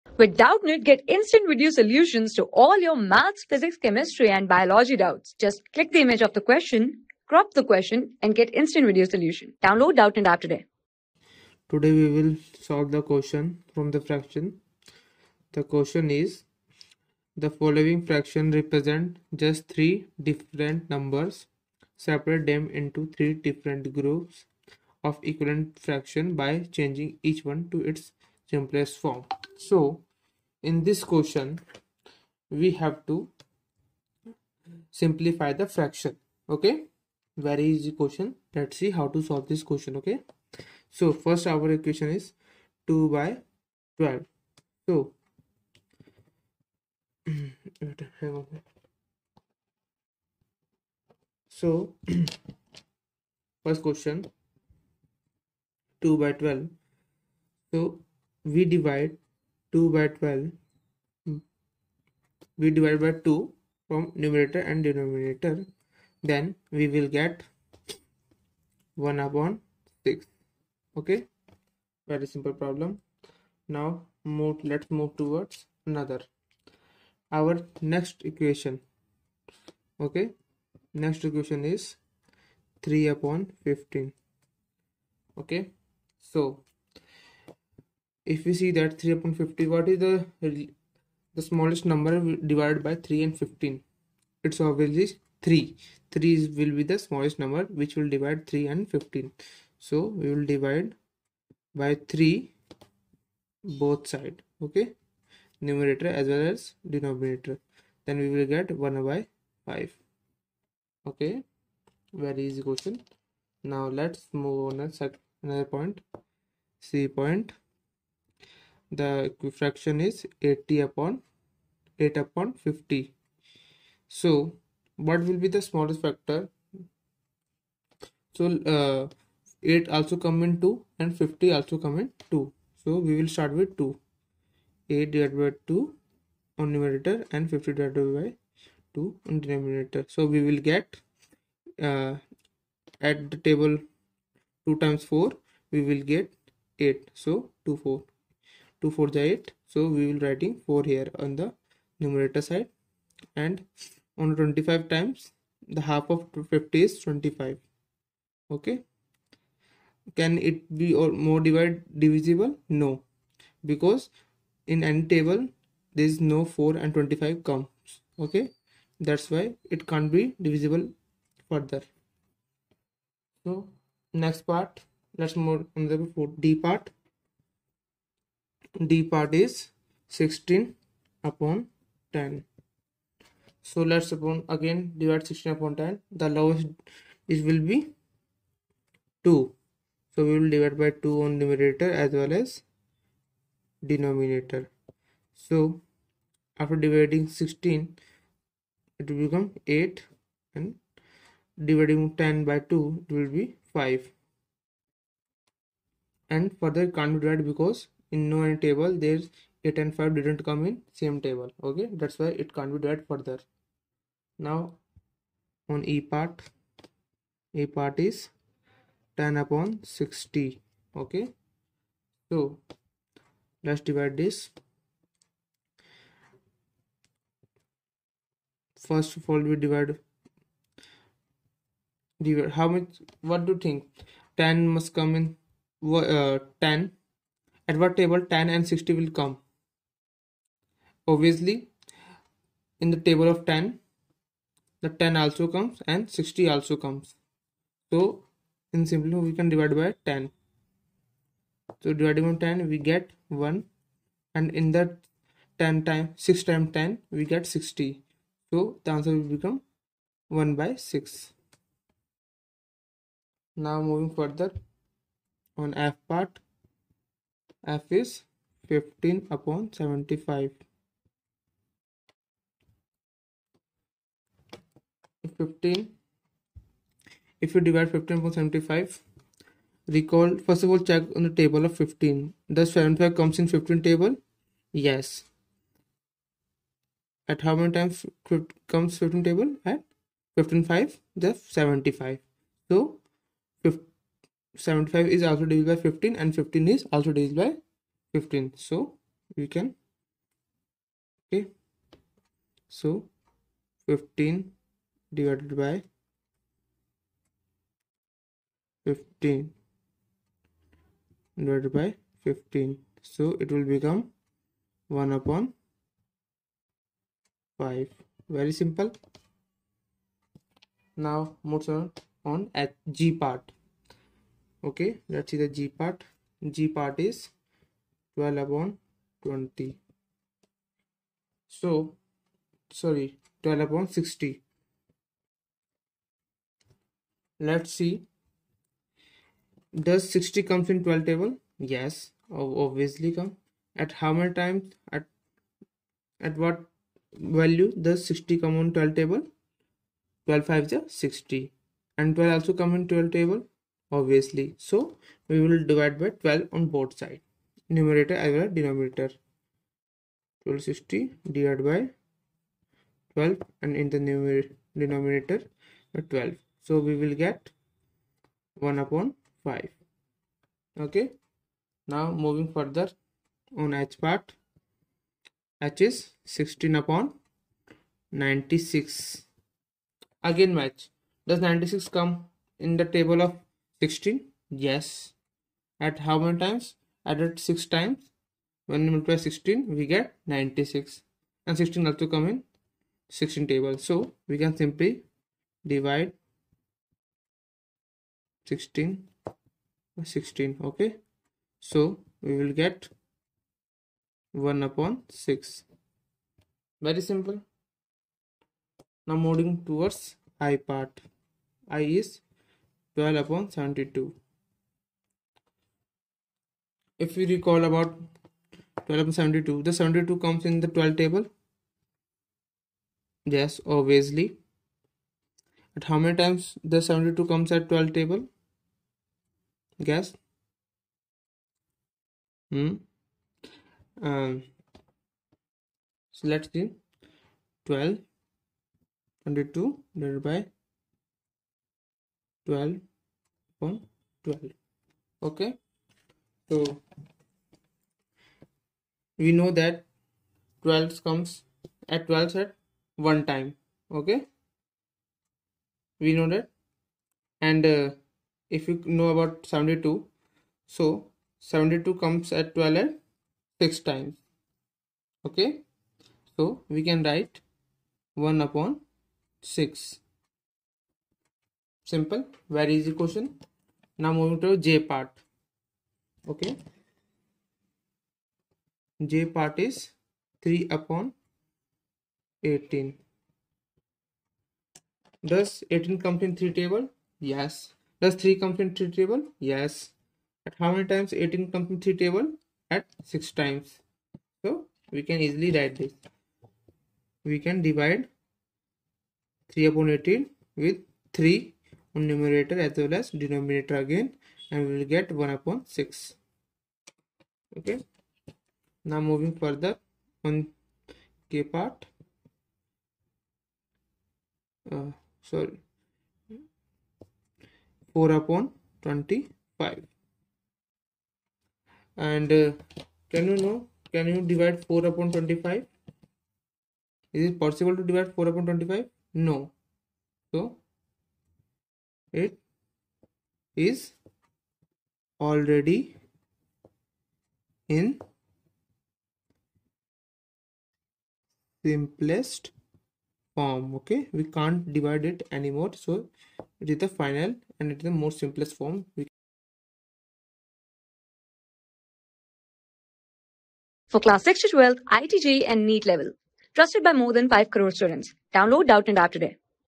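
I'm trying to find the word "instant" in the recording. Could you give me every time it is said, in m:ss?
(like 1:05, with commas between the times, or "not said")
0:01, 0:08.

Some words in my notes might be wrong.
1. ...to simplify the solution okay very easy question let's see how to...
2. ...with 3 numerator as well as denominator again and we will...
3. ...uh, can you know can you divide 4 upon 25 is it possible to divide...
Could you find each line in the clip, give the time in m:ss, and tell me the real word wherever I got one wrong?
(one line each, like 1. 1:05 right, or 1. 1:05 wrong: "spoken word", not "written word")
1. 0:33 wrong: "fraction", not "solution"
2. 8:20 right
3. 8:42 right.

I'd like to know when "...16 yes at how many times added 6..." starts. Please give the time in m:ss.
6:23.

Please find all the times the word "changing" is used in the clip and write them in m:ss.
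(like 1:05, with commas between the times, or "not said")
0:26.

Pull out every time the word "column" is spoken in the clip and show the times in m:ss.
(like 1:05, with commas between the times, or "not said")
not said.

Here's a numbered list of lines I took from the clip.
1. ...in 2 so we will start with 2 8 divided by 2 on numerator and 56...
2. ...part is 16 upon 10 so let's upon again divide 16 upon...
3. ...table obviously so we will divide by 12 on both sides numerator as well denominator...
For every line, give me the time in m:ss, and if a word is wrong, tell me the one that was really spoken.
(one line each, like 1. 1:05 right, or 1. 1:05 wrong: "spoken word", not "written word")
1. 2:11 wrong: "50", not "56"
2. 2:59 right
3. 5:53 right.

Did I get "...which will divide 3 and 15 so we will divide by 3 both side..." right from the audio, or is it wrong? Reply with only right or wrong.
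right.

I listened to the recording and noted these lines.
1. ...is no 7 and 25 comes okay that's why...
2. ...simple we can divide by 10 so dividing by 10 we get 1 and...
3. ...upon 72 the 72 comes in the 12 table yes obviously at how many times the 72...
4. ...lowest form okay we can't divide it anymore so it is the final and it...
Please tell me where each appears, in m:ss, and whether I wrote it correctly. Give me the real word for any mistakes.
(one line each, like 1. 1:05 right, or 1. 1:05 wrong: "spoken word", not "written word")
1. 2:46 wrong: "4", not "7"
2. 4:08 right
3. 6:59 right
4. 9:01 wrong: "simplest", not "lowest".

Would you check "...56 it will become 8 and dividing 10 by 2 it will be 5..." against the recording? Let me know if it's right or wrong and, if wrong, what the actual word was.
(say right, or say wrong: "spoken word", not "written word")
wrong: "16", not "56".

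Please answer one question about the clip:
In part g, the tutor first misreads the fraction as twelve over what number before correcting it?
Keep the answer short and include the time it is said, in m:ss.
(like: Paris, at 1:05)
20, at 5:28.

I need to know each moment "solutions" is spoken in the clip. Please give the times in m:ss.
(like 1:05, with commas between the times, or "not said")
0:01, 0:09.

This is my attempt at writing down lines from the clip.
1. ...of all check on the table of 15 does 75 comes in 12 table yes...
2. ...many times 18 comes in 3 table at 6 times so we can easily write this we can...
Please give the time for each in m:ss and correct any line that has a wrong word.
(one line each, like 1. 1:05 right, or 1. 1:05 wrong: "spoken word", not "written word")
1. 4:40 wrong: "15", not "12"
2. 8:10 right.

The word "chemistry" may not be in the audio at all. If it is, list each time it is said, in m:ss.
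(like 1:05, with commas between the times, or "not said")
0:03.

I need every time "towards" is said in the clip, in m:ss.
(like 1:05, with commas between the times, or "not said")
1:15, 6:49.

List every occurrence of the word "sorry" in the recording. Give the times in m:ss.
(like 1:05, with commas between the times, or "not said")
5:32, 8:35.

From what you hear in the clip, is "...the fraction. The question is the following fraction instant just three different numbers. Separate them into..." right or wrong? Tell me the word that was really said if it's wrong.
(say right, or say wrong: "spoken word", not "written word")
wrong: "represent", not "instant".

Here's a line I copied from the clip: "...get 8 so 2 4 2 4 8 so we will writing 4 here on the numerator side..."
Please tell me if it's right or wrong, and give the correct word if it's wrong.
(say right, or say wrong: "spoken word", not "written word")
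right.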